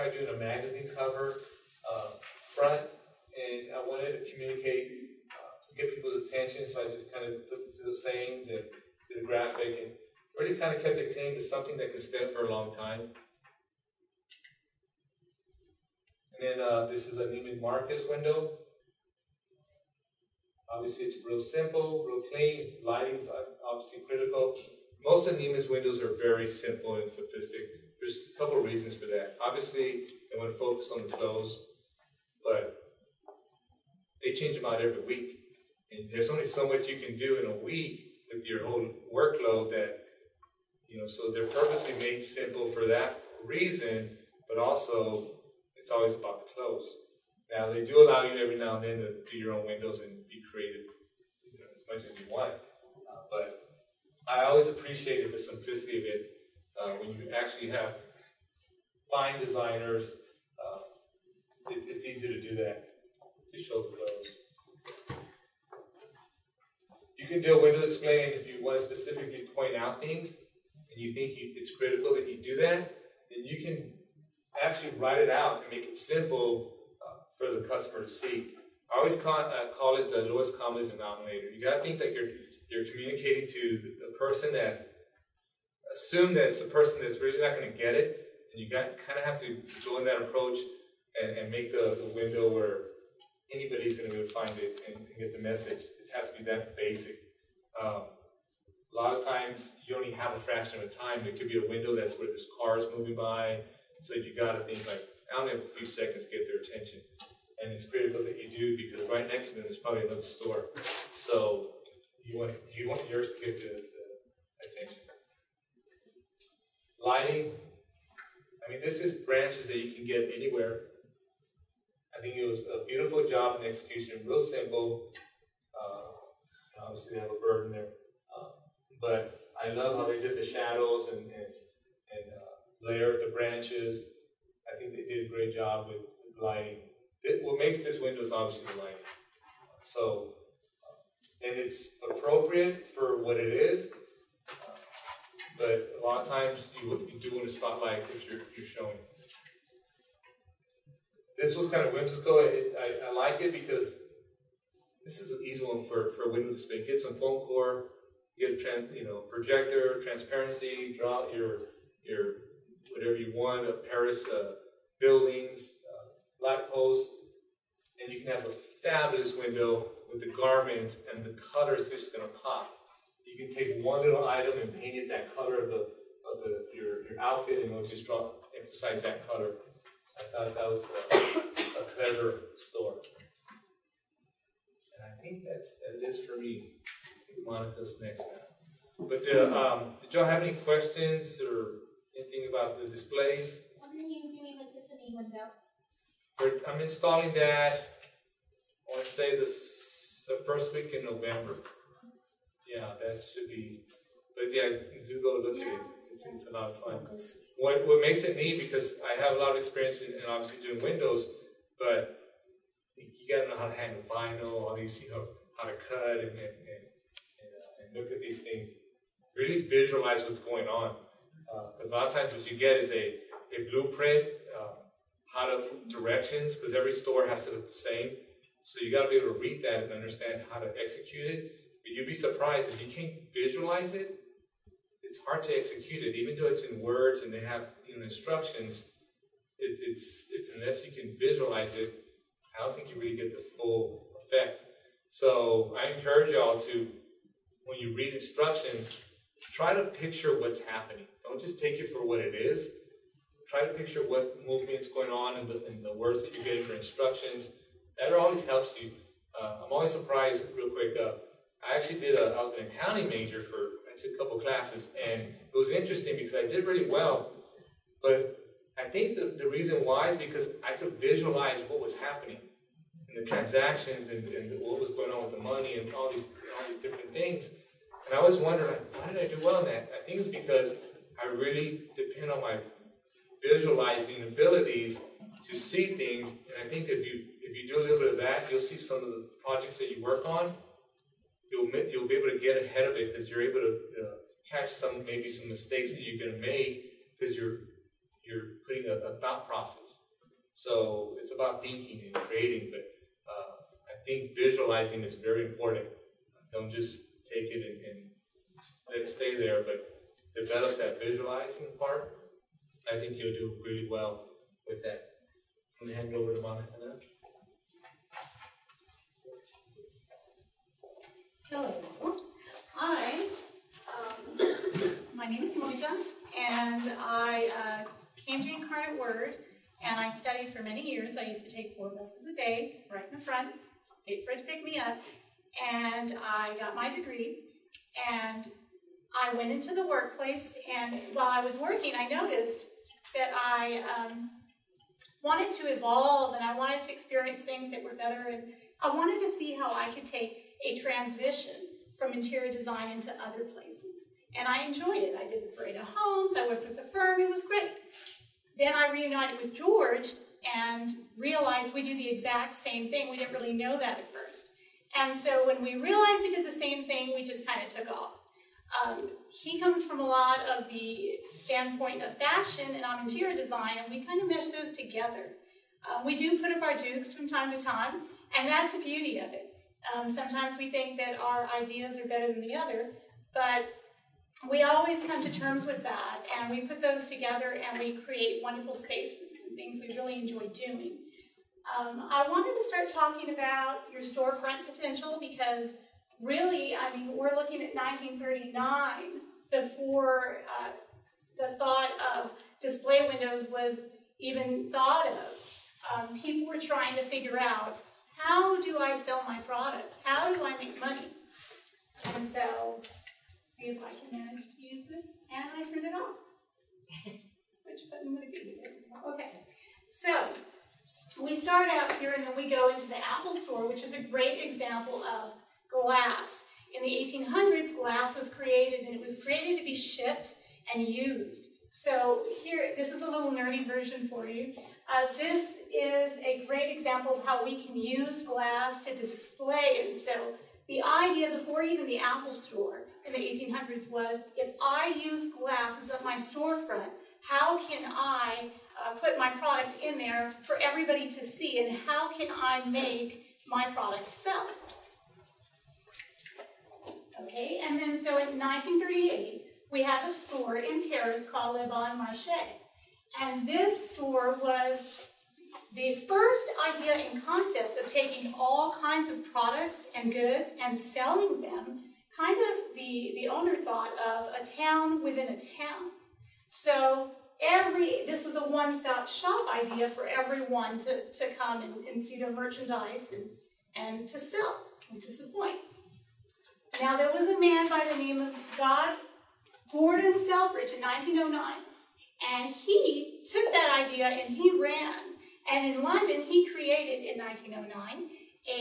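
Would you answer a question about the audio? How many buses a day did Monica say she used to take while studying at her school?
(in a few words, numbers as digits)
4.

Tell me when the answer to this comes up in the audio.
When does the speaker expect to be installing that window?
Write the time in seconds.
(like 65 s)
200 s.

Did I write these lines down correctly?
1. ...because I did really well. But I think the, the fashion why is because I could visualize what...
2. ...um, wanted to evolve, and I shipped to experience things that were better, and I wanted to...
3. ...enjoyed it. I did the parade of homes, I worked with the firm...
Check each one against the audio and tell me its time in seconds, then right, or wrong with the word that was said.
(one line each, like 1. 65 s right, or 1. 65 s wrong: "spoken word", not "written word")
1. 266 s wrong: "reason", not "fashion"
2. 343 s wrong: "wanted", not "shipped"
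3. 354 s right.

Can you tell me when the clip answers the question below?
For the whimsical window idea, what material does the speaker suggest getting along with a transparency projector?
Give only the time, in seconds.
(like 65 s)
157 s.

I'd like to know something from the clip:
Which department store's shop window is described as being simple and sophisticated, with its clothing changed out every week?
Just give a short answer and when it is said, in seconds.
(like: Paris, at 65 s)
Neiman Marcus, at 17 s.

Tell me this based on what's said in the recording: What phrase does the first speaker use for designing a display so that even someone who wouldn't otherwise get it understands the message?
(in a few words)
lowest common denominator.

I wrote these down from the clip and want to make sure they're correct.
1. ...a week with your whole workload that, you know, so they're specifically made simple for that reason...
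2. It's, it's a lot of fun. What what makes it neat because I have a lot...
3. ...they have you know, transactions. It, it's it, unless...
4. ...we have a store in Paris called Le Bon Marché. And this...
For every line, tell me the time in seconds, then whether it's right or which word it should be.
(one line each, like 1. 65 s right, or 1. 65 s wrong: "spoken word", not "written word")
1. 37 s wrong: "purposely", not "specifically"
2. 206 s right
3. 237 s wrong: "instructions", not "transactions"
4. 459 s right.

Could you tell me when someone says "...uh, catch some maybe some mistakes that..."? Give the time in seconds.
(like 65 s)
293 s.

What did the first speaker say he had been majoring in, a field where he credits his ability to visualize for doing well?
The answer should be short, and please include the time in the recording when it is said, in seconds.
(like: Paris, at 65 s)
accounting, at 262 s.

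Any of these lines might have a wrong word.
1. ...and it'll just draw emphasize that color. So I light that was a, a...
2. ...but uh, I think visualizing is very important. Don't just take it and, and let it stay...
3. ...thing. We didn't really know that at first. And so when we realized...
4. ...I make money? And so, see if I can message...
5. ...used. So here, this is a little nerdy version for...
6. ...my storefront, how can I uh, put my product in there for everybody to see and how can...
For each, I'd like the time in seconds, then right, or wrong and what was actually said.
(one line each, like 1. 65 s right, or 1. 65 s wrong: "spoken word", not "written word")
1. 177 s wrong: "thought", not "light"
2. 302 s right
3. 362 s right
4. 410 s wrong: "manage", not "message"
5. 430 s right
6. 446 s right.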